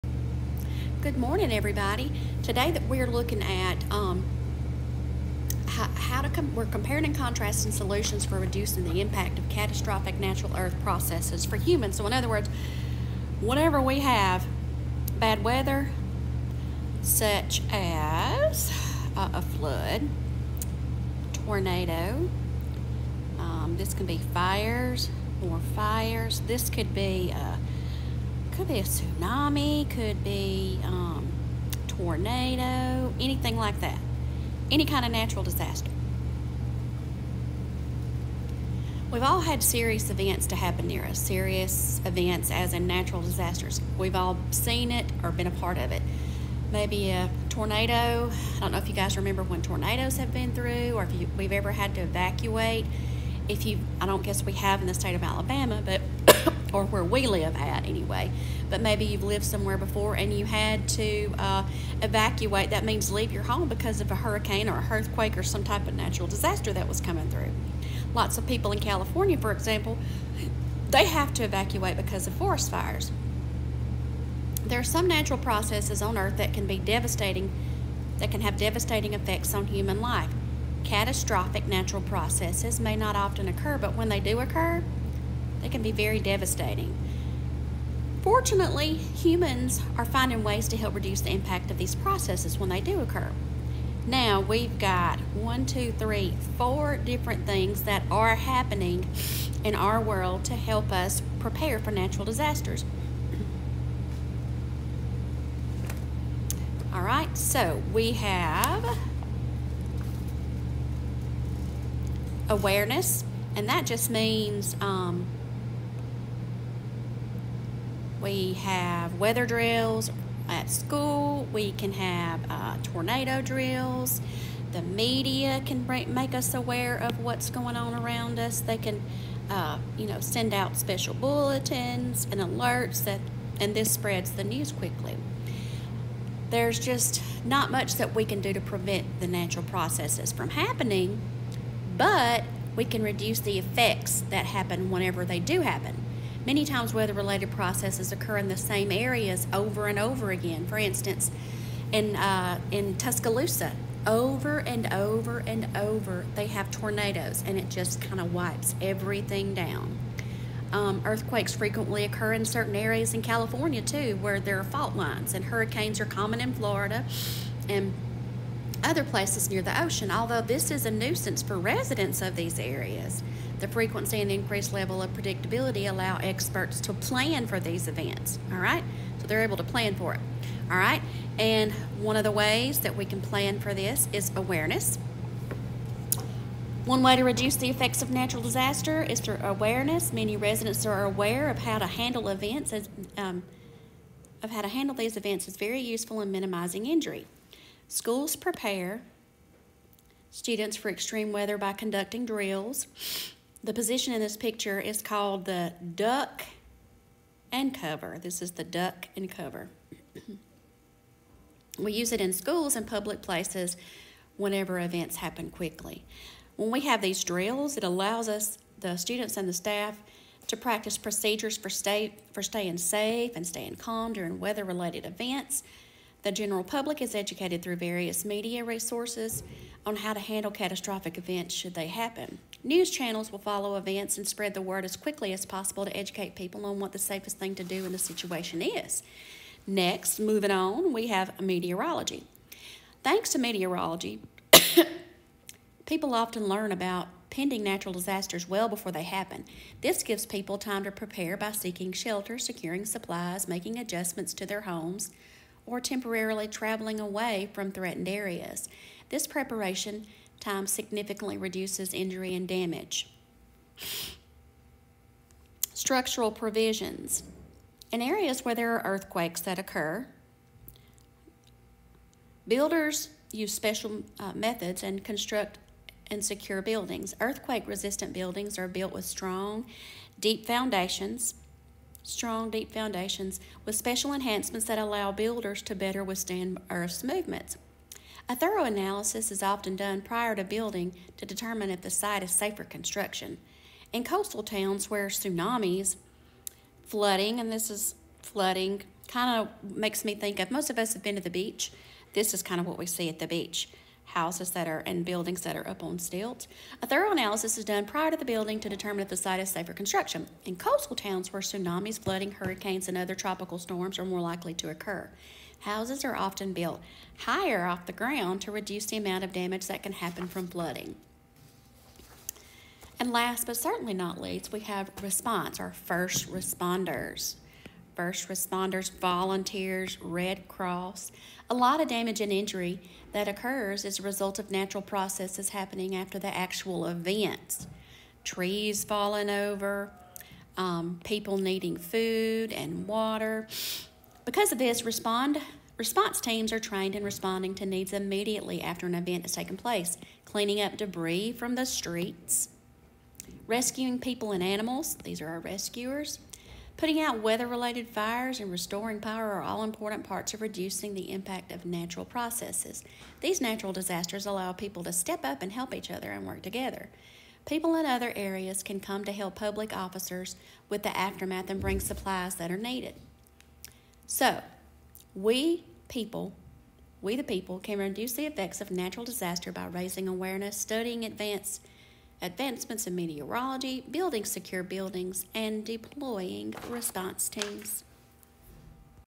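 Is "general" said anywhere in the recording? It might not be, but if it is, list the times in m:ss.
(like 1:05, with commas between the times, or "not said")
3:46.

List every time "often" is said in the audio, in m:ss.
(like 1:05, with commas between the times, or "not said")
1:23, 4:06, 4:49, 5:16.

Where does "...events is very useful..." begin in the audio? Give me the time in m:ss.
3:15.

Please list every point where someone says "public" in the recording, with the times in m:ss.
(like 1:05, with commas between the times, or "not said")
3:32, 3:46, 6:09.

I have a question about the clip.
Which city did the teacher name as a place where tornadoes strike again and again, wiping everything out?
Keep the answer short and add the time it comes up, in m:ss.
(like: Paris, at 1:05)
Tuscaloosa, at 2:32.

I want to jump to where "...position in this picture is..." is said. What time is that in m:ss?
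3:23.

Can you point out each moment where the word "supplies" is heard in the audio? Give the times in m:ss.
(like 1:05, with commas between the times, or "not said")
4:12, 6:11.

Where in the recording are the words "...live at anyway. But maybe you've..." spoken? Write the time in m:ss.
0:57.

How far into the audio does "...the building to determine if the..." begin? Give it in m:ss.
5:08.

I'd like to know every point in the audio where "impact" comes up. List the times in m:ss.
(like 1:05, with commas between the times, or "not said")
0:09, 1:31, 6:01.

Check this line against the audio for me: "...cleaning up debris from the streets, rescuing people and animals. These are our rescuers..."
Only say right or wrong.
right.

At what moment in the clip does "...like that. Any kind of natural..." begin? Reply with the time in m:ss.
0:33.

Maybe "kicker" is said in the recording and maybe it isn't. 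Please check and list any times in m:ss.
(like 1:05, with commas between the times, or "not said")
not said.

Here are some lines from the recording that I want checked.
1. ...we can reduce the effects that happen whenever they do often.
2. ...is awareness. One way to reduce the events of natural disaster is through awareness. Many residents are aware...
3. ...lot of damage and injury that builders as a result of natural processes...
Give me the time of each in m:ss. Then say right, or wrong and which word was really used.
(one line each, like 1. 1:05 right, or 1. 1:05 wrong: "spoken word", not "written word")
1. 2:22 wrong: "happen", not "often"
2. 3:04 wrong: "effects", not "events"
3. 5:31 wrong: "occurs", not "builders".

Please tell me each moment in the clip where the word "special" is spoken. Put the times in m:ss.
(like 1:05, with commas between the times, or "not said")
2:10, 4:33, 4:43.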